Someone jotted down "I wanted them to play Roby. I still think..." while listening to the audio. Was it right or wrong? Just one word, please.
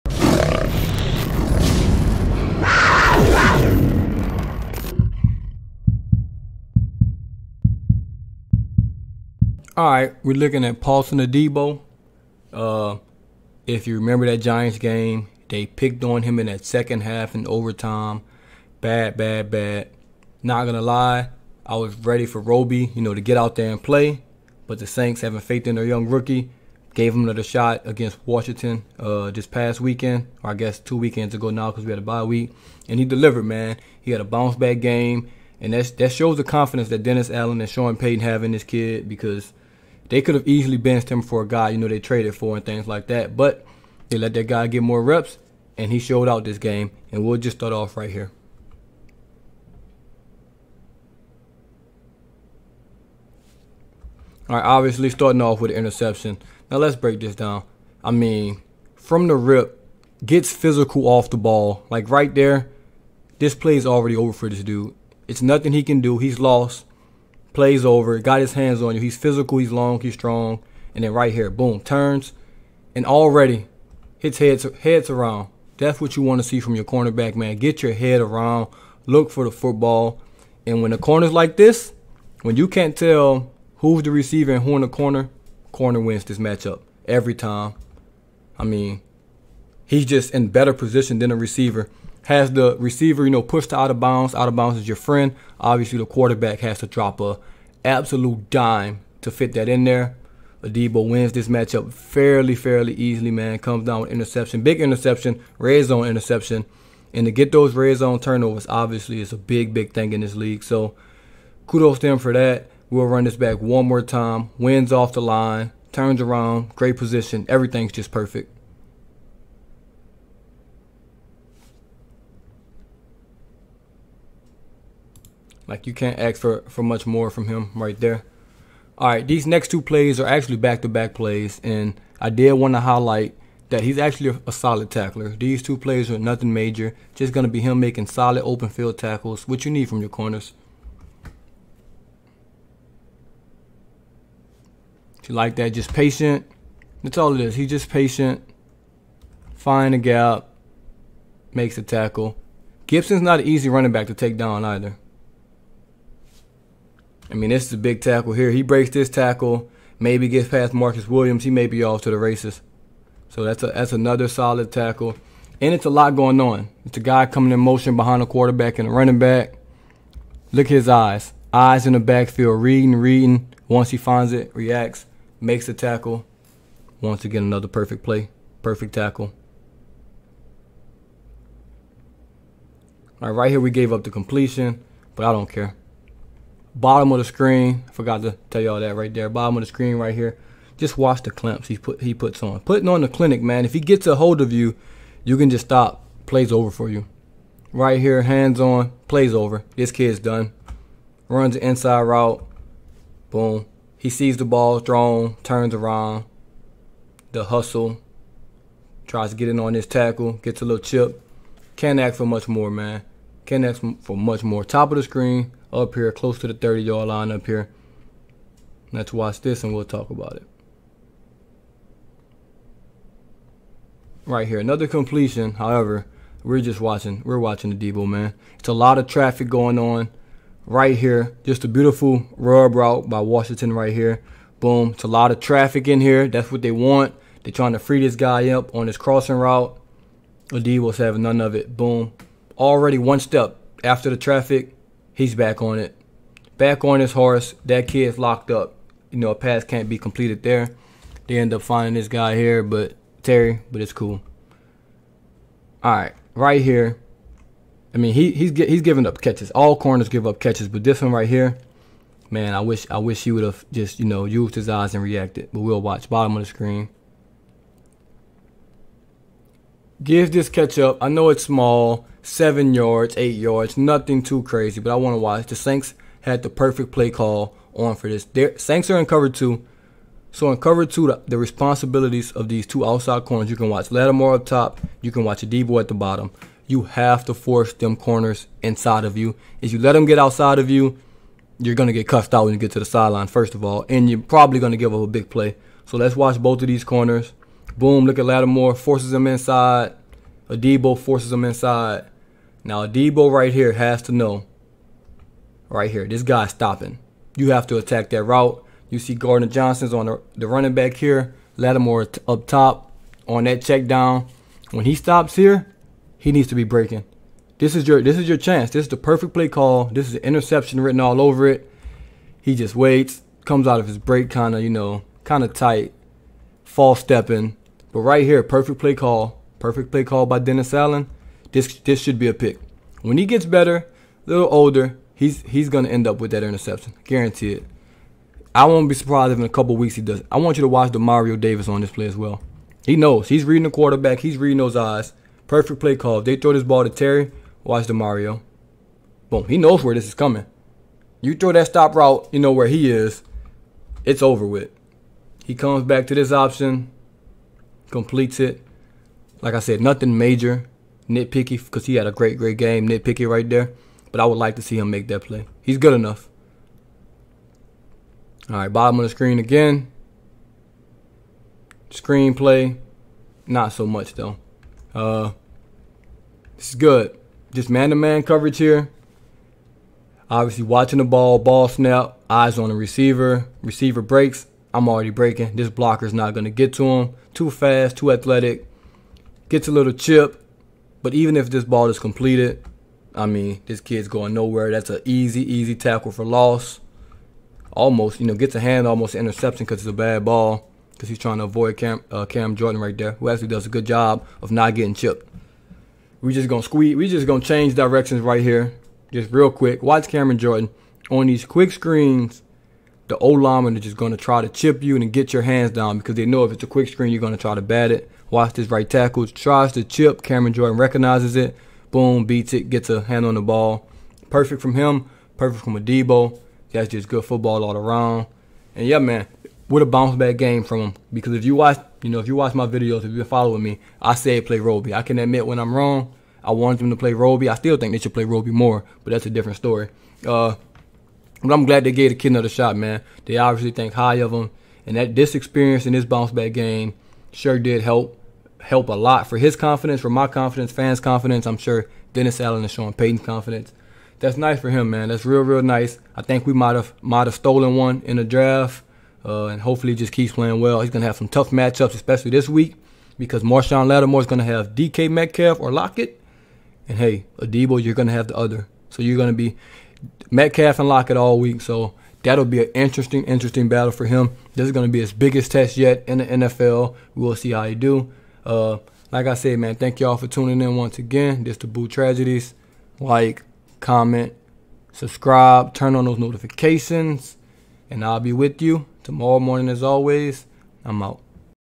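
right.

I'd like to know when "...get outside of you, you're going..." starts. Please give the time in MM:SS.
04:50.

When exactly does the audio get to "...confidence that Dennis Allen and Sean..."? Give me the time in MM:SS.
00:36.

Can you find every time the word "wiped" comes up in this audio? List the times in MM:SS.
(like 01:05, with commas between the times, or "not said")
not said.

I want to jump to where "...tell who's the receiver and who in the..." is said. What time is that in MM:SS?
01:22.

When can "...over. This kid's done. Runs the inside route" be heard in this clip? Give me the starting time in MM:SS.
03:19.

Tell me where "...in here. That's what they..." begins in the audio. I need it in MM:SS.
03:55.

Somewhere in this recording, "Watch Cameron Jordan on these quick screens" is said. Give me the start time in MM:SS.
06:49.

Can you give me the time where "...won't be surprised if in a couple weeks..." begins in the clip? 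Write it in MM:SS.
05:38.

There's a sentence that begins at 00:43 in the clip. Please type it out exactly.
But they let that guy get more reps, and he showed out this game.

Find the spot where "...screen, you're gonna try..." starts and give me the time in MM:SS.
06:56.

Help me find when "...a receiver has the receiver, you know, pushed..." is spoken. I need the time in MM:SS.
01:31.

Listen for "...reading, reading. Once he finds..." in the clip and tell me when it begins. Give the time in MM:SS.
02:52.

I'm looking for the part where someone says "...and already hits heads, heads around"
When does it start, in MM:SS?
01:12.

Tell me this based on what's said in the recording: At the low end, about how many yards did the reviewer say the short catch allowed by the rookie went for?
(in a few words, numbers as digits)
7.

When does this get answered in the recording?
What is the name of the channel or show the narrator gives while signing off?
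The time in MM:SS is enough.
08:01.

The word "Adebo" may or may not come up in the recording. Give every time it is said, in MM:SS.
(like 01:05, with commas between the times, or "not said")
00:11, 01:40, 04:45, 05:00, 07:05, 07:47.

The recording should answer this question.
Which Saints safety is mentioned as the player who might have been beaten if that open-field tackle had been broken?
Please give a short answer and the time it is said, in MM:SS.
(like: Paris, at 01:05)
Marcus Williams, at 02:40.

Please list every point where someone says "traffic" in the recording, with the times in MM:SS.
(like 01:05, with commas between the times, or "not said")
03:49, 03:55, 04:04.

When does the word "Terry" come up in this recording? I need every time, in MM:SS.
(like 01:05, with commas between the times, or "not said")
04:13, 05:46.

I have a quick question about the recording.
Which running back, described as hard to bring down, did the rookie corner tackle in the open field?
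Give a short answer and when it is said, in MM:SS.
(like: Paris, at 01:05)
Gibson, at 02:32.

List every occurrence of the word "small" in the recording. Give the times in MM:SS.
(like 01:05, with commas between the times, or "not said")
04:31.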